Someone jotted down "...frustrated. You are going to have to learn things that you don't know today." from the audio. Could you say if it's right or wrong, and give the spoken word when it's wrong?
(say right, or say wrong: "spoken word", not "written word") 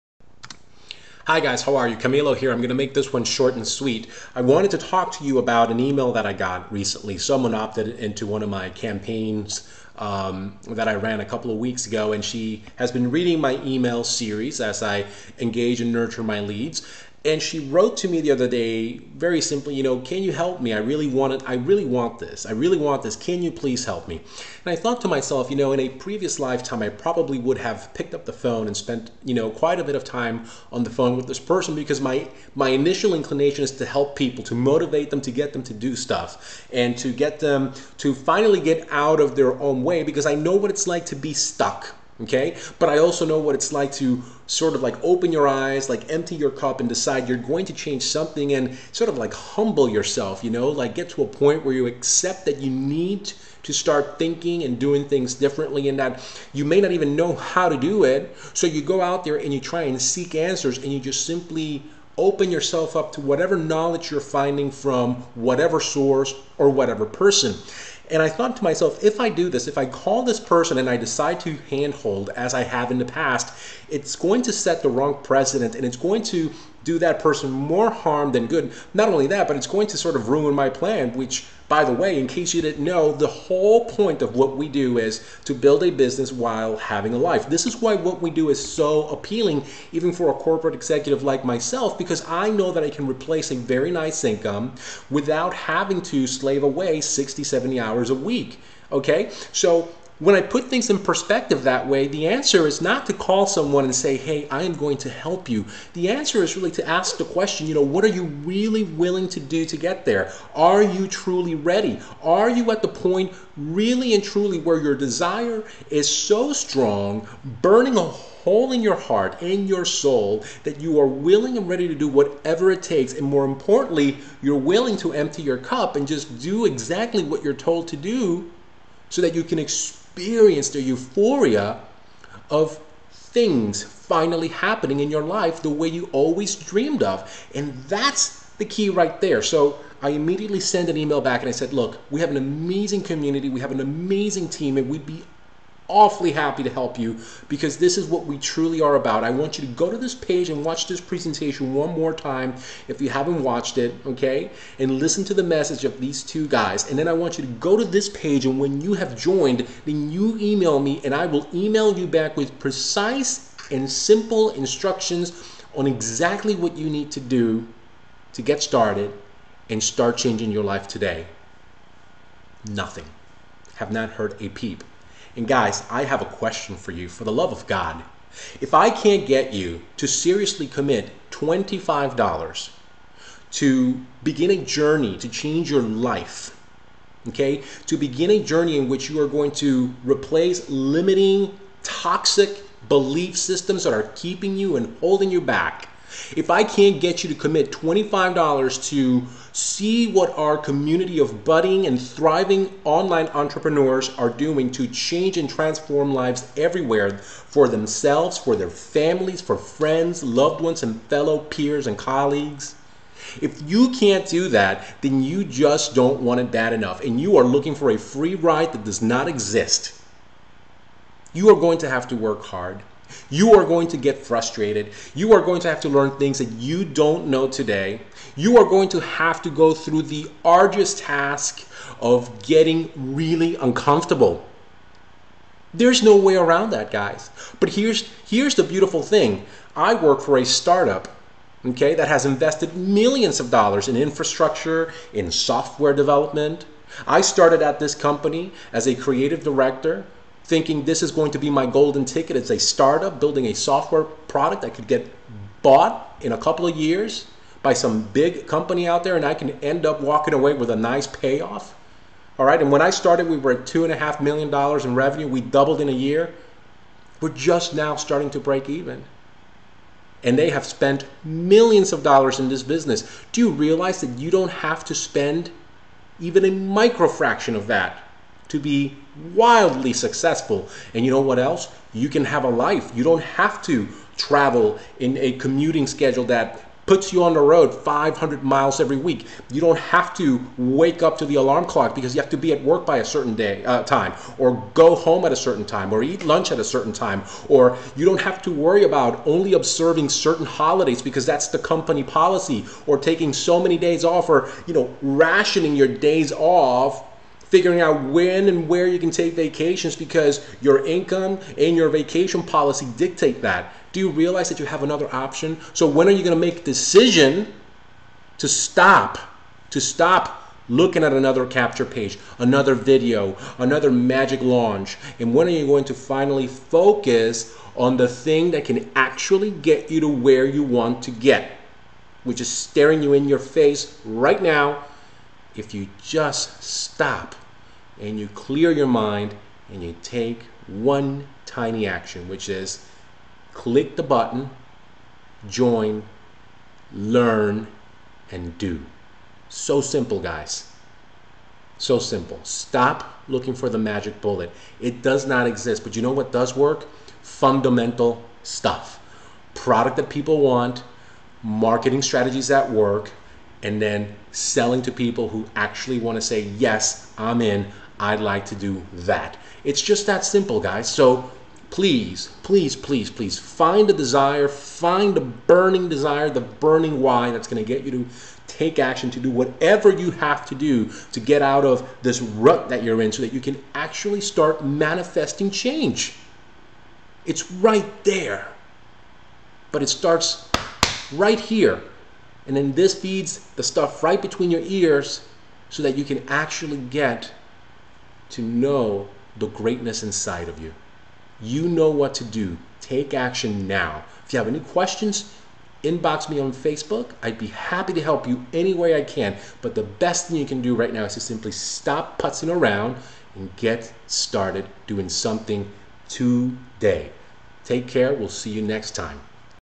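right.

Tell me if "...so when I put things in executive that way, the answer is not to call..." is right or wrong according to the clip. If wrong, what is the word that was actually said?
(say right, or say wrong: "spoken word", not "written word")
wrong: "perspective", not "executive".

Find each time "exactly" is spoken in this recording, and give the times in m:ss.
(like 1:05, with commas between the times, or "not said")
2:06, 2:45.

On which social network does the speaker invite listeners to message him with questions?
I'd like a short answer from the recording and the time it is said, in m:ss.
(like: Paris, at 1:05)
Facebook, at 6:46.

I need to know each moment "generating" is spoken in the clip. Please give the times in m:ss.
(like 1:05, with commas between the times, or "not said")
not said.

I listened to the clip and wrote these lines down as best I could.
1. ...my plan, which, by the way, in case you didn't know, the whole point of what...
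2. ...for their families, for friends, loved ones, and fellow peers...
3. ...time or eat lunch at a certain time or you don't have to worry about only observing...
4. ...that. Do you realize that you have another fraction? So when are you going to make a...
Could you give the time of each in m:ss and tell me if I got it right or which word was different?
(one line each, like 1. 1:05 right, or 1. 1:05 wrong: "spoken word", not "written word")
1. 1:20 right
2. 3:28 right
3. 4:55 right
4. 5:13 wrong: "option", not "fraction".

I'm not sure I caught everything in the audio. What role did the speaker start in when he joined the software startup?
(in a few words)
creative director.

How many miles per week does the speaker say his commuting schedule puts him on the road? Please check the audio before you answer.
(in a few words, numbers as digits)
500.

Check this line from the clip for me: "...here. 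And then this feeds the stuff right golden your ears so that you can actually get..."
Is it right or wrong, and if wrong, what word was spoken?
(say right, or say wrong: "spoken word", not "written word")
wrong: "between", not "golden".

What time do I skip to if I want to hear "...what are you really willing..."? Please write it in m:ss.
1:47.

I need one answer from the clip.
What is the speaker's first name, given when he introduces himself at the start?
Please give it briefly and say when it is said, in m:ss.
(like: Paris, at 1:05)
Camilo, at 0:01.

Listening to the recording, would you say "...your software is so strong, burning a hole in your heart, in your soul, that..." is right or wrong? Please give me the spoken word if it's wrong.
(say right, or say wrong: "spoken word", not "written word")
wrong: "desire", not "software".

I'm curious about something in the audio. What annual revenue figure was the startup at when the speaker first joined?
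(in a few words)
$2.5 million.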